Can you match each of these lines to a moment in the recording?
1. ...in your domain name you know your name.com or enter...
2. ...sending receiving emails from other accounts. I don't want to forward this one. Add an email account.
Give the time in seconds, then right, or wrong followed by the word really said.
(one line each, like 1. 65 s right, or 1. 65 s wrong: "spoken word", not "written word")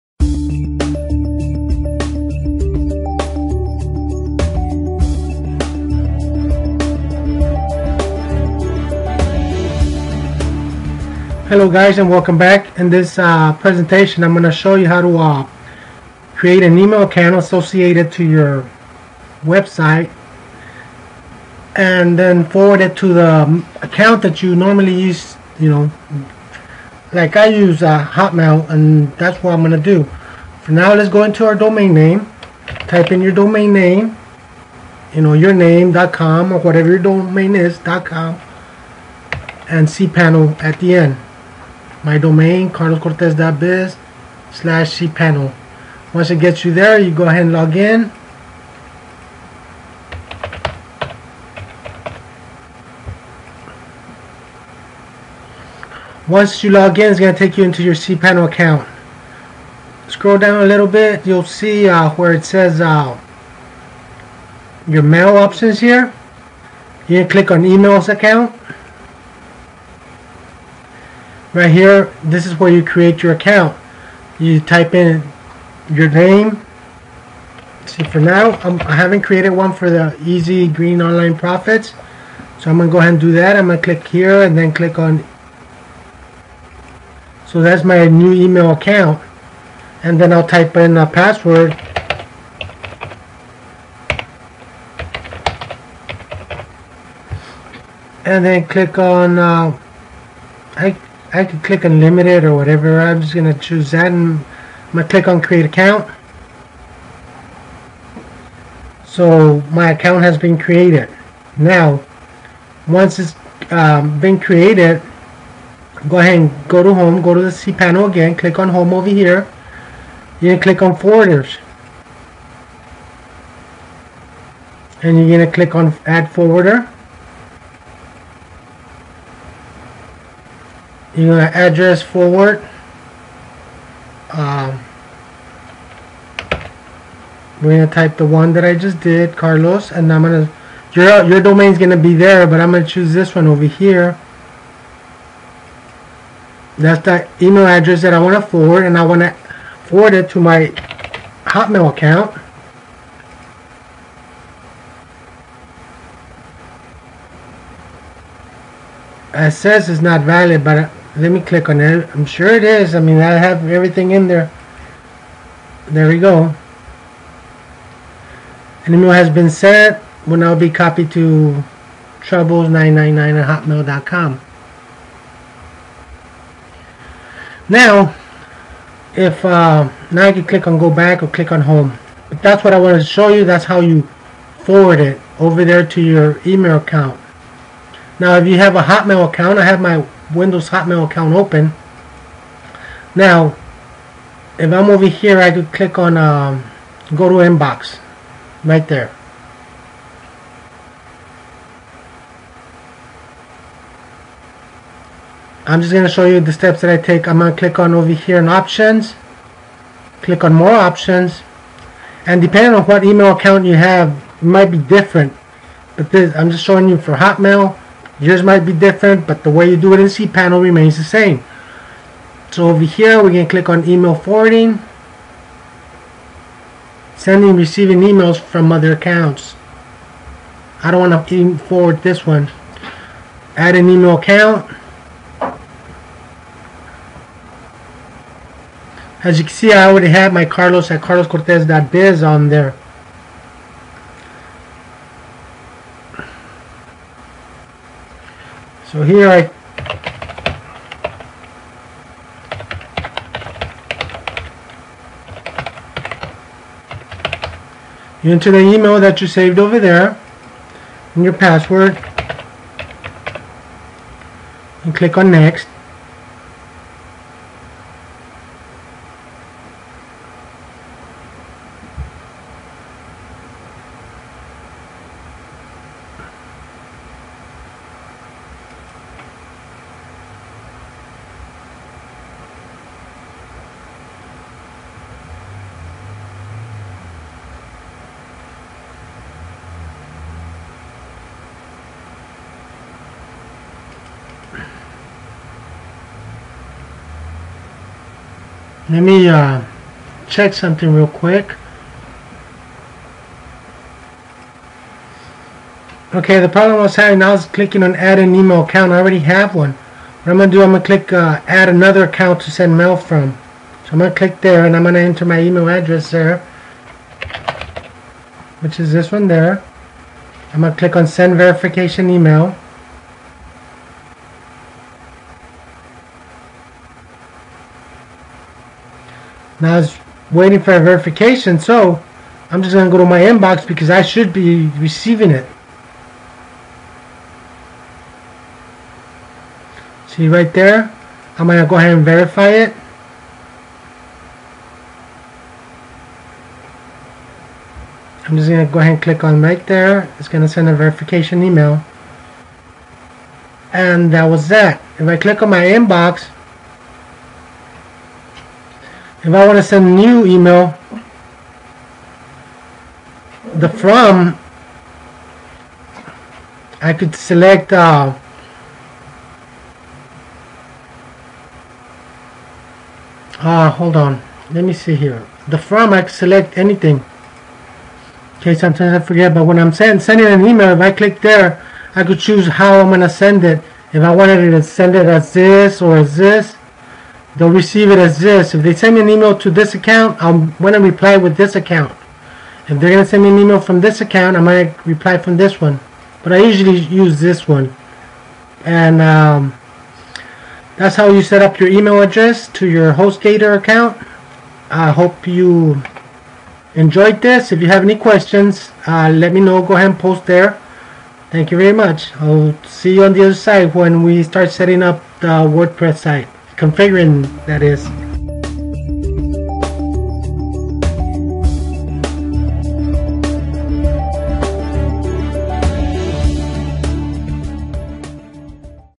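1. 33 s wrong: "whatever", not "enter"
2. 227 s right.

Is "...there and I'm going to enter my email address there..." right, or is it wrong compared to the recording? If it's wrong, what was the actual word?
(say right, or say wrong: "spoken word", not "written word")
right.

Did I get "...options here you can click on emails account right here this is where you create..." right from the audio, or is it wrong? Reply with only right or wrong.
right.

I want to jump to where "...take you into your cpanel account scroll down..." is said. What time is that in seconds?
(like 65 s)
57 s.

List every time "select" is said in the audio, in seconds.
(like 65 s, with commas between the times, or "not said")
367 s, 376 s.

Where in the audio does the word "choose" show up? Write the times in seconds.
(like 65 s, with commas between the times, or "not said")
103 s, 142 s, 382 s.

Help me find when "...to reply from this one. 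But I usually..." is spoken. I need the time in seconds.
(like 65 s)
394 s.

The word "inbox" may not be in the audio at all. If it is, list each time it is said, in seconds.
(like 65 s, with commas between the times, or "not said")
197 s, 333 s, 355 s.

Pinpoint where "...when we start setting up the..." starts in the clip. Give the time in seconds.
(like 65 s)
413 s.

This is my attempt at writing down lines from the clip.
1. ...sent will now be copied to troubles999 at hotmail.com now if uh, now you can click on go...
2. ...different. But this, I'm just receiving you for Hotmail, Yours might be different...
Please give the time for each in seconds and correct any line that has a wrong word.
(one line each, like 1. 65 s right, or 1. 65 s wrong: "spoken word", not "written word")
1. 169 s right
2. 214 s wrong: "showing", not "receiving".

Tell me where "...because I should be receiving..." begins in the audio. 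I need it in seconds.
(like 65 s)
333 s.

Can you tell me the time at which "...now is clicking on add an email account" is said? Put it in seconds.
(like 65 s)
307 s.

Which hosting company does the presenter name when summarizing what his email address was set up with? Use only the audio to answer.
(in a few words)
HostGator.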